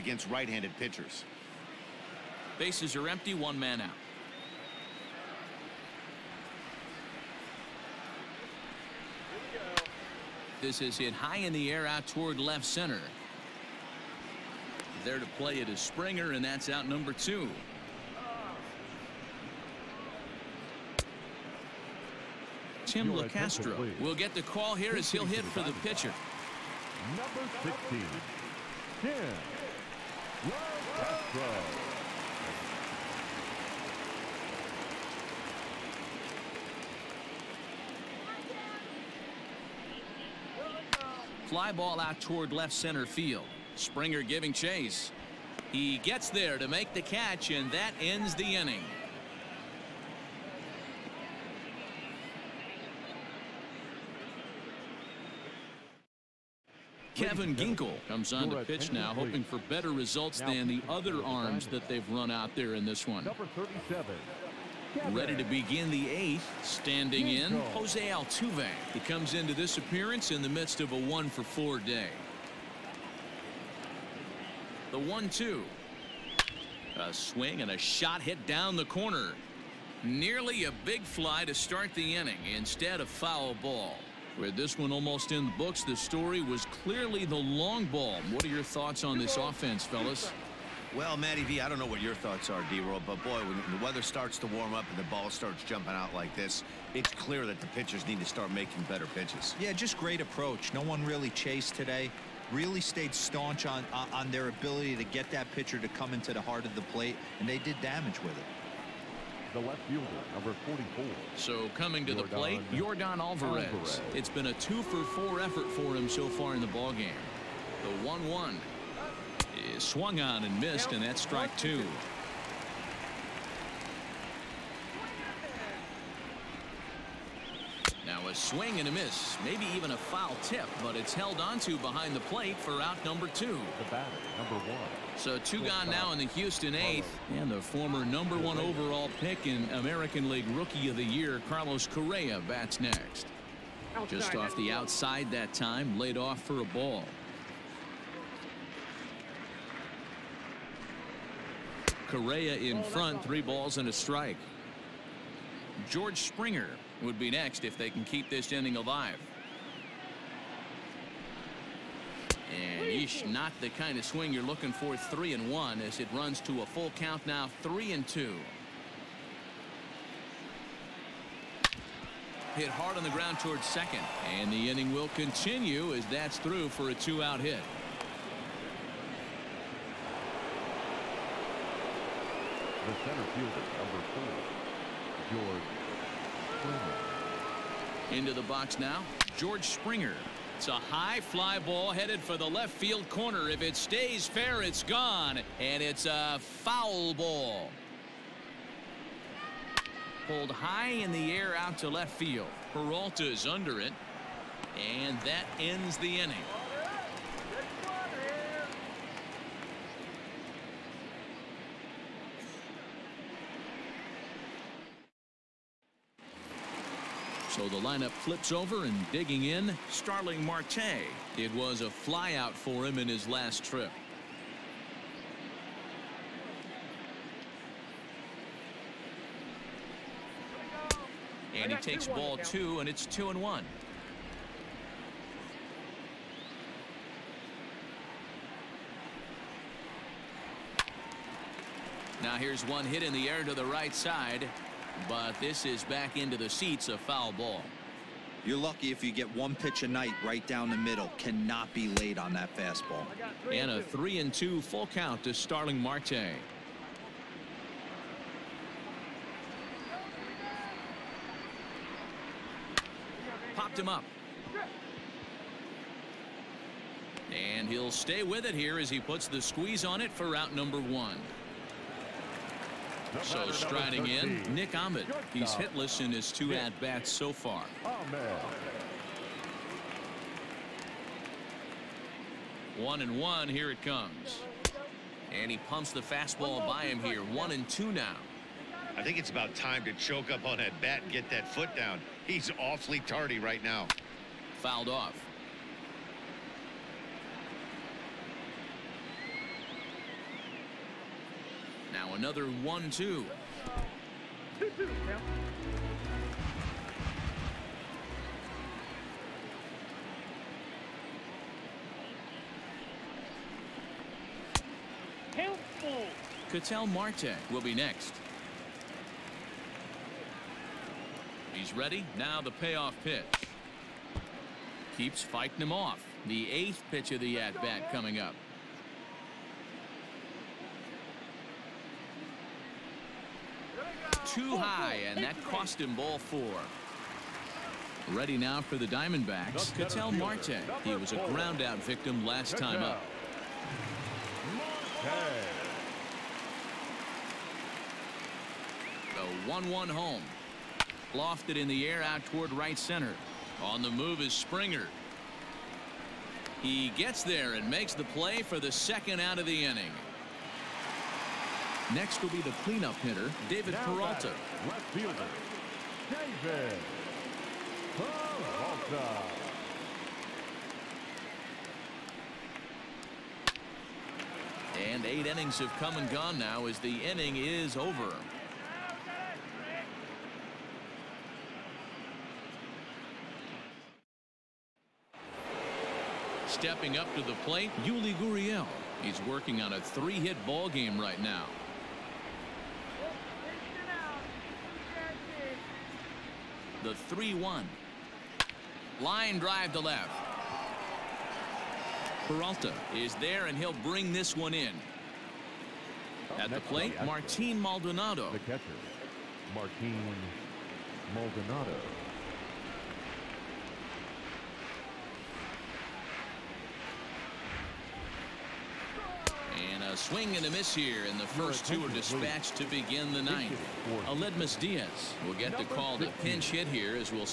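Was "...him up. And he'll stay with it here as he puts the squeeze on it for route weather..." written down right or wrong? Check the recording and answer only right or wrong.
wrong.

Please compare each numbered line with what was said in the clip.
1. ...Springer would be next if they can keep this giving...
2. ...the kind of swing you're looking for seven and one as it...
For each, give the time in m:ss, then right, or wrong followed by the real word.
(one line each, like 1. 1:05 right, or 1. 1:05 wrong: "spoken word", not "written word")
1. 2:36 wrong: "inning", not "giving"
2. 2:43 wrong: "three", not "seven".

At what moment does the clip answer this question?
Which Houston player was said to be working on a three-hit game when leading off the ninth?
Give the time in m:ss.
6:27.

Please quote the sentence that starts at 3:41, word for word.
It was a flyout for him in his last trip.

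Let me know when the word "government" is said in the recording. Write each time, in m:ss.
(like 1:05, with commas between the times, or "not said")
not said.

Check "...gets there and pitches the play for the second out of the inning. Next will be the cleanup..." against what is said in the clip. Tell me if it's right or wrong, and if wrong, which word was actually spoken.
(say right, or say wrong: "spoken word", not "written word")
wrong: "makes", not "pitches".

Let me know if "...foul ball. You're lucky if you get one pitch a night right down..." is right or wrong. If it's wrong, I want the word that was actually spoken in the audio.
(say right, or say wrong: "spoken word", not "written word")
right.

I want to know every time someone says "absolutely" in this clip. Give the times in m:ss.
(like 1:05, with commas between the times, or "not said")
not said.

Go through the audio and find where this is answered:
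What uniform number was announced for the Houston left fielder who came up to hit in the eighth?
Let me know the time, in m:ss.
1:50.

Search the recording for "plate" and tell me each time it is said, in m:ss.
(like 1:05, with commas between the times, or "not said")
1:46, 1:52, 2:12, 6:27, 6:46.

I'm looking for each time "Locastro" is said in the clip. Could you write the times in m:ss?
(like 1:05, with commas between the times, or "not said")
0:23, 0:30.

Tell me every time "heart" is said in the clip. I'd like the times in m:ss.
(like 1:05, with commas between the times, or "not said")
1:46.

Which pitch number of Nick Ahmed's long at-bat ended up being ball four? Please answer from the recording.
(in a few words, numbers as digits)
8.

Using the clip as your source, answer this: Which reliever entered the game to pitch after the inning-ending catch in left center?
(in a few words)
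Kevin Ginkel.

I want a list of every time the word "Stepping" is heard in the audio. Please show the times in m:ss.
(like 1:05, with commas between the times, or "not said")
6:26.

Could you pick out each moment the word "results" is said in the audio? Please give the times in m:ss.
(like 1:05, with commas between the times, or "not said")
0:59.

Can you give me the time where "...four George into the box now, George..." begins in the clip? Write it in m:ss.
3:04.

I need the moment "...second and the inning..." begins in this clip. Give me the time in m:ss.
2:53.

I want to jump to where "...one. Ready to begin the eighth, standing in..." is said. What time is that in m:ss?
1:03.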